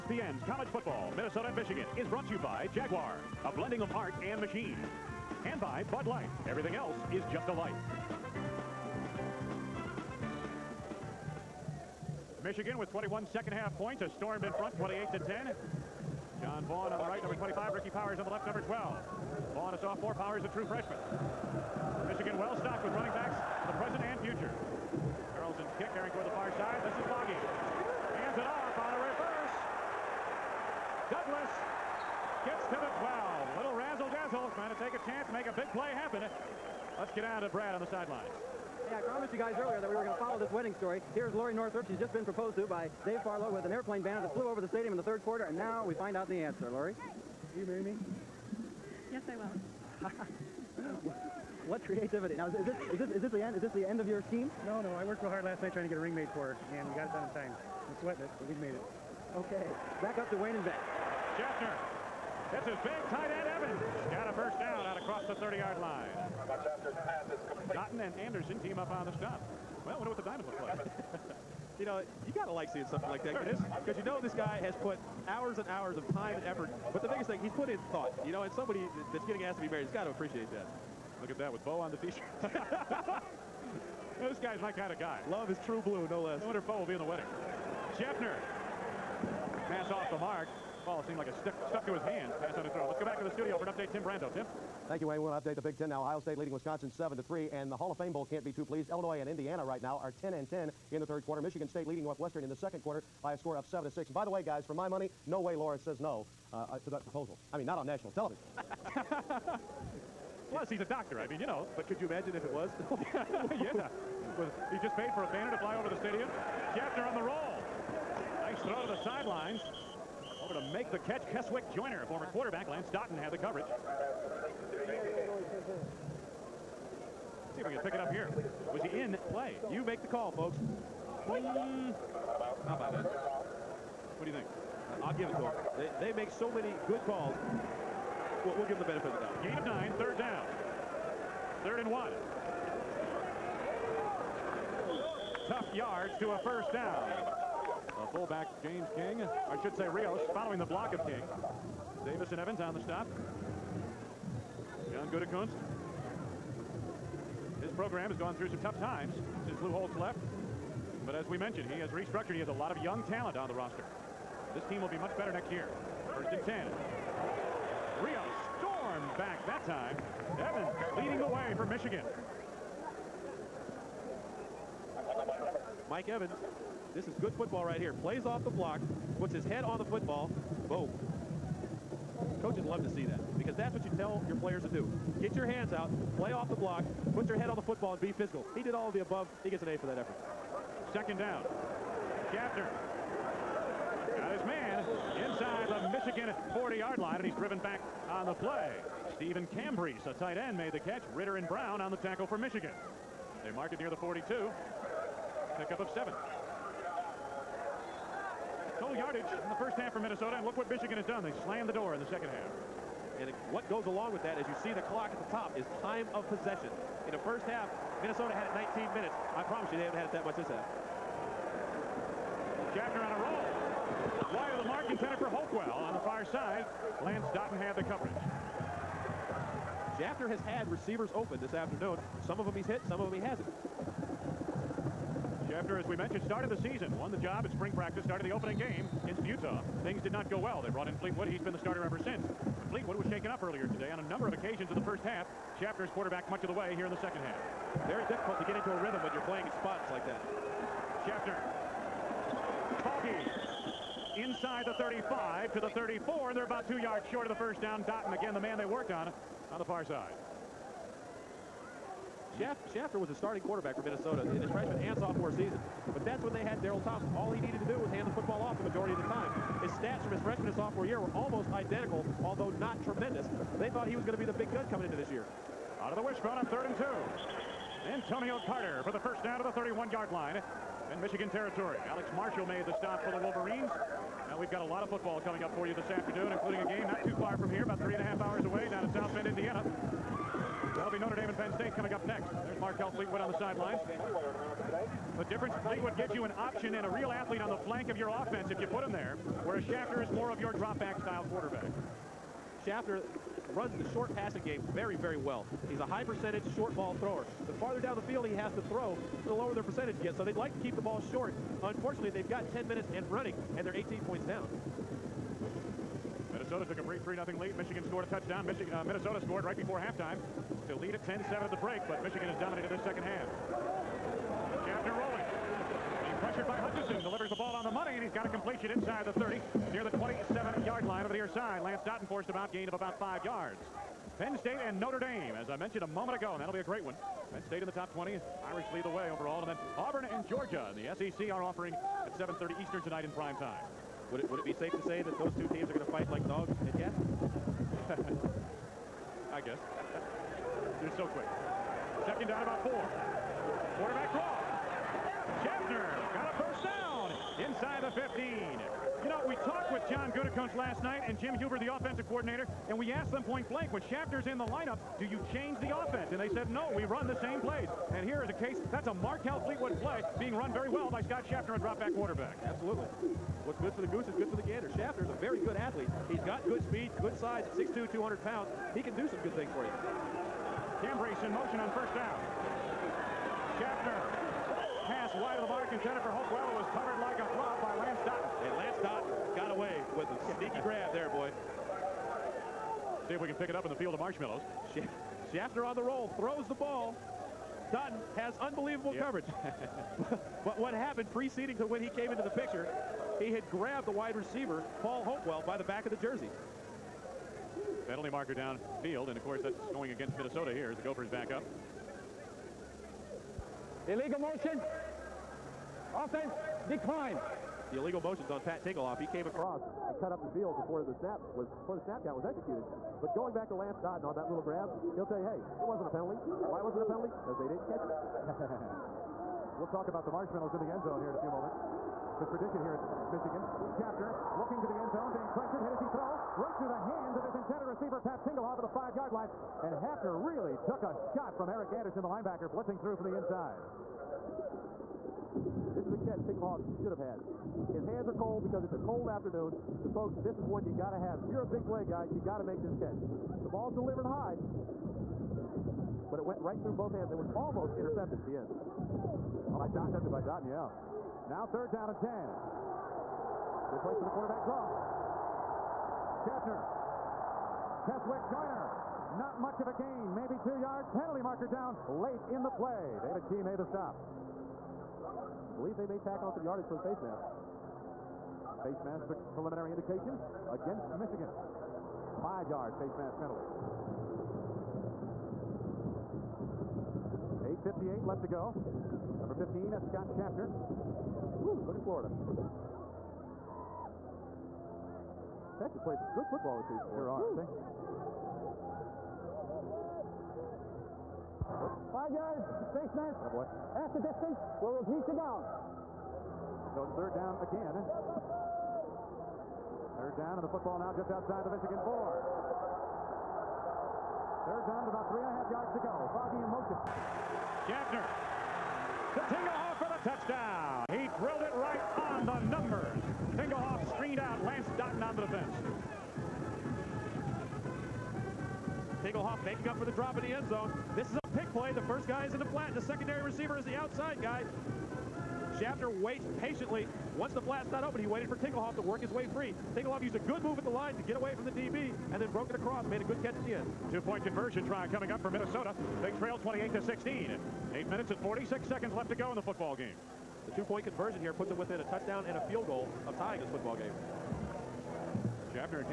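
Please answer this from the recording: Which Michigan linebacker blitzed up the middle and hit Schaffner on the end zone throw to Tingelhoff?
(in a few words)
Erick Anderson.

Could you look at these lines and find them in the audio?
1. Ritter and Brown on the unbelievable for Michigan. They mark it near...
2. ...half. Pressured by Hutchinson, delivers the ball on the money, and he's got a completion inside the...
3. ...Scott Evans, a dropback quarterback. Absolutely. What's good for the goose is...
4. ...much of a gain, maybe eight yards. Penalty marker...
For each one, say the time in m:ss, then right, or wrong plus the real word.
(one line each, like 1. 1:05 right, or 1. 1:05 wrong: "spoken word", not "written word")
1. 3:21 wrong: "tackle", not "unbelievable"
2. 5:23 right
3. 6:11 wrong: "Schaffner", not "Evans"
4. 7:49 wrong: "two", not "eight".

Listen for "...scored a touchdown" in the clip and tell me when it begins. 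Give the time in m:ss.
5:17.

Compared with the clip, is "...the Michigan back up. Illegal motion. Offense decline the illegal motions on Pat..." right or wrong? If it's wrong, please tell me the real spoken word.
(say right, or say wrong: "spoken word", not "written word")
wrong: "Gophers", not "Michigan".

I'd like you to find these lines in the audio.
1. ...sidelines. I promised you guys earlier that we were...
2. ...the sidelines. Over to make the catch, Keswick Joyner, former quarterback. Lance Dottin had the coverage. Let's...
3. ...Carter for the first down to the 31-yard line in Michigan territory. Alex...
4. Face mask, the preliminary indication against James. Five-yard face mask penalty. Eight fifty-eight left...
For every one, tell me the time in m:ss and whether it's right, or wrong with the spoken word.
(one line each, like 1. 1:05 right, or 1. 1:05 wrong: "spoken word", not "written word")
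1. 0:37 right
2. 1:58 right
3. 4:38 right
4. 7:58 wrong: "Michigan", not "James".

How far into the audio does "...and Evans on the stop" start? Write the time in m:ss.
2:32.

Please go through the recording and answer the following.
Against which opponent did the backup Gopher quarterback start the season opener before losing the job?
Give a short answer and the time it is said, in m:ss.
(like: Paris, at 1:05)
Utah, at 3:59.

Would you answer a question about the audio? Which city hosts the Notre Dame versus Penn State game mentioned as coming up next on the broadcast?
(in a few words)
South Bend, Indiana.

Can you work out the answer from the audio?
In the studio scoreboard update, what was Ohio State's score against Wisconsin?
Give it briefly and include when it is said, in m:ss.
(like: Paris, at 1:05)
7 to 3, at 1:36.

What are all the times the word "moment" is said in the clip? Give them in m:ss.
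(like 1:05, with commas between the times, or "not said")
5:35, 7:11.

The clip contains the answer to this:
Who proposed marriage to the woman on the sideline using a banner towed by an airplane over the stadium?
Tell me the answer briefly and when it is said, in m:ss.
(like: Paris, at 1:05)
Dave Farlow, at 0:43.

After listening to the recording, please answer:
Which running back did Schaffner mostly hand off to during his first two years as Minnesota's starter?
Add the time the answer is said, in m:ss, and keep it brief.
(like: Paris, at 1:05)
Darrell Thompson, at 4:26.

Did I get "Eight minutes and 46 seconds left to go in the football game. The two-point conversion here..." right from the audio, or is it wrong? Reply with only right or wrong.
right.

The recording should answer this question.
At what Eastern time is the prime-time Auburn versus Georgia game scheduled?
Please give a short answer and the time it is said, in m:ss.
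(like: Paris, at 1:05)
7:30, at 5:42.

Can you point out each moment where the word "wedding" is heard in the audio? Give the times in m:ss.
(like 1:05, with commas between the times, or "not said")
0:40, 1:27.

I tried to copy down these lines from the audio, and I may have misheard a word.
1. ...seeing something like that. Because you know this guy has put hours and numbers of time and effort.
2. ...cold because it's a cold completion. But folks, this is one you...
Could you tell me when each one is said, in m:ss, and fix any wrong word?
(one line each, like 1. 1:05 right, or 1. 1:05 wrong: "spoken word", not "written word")
1. 1:12 wrong: "hours", not "numbers"
2. 7:28 wrong: "afternoon", not "completion".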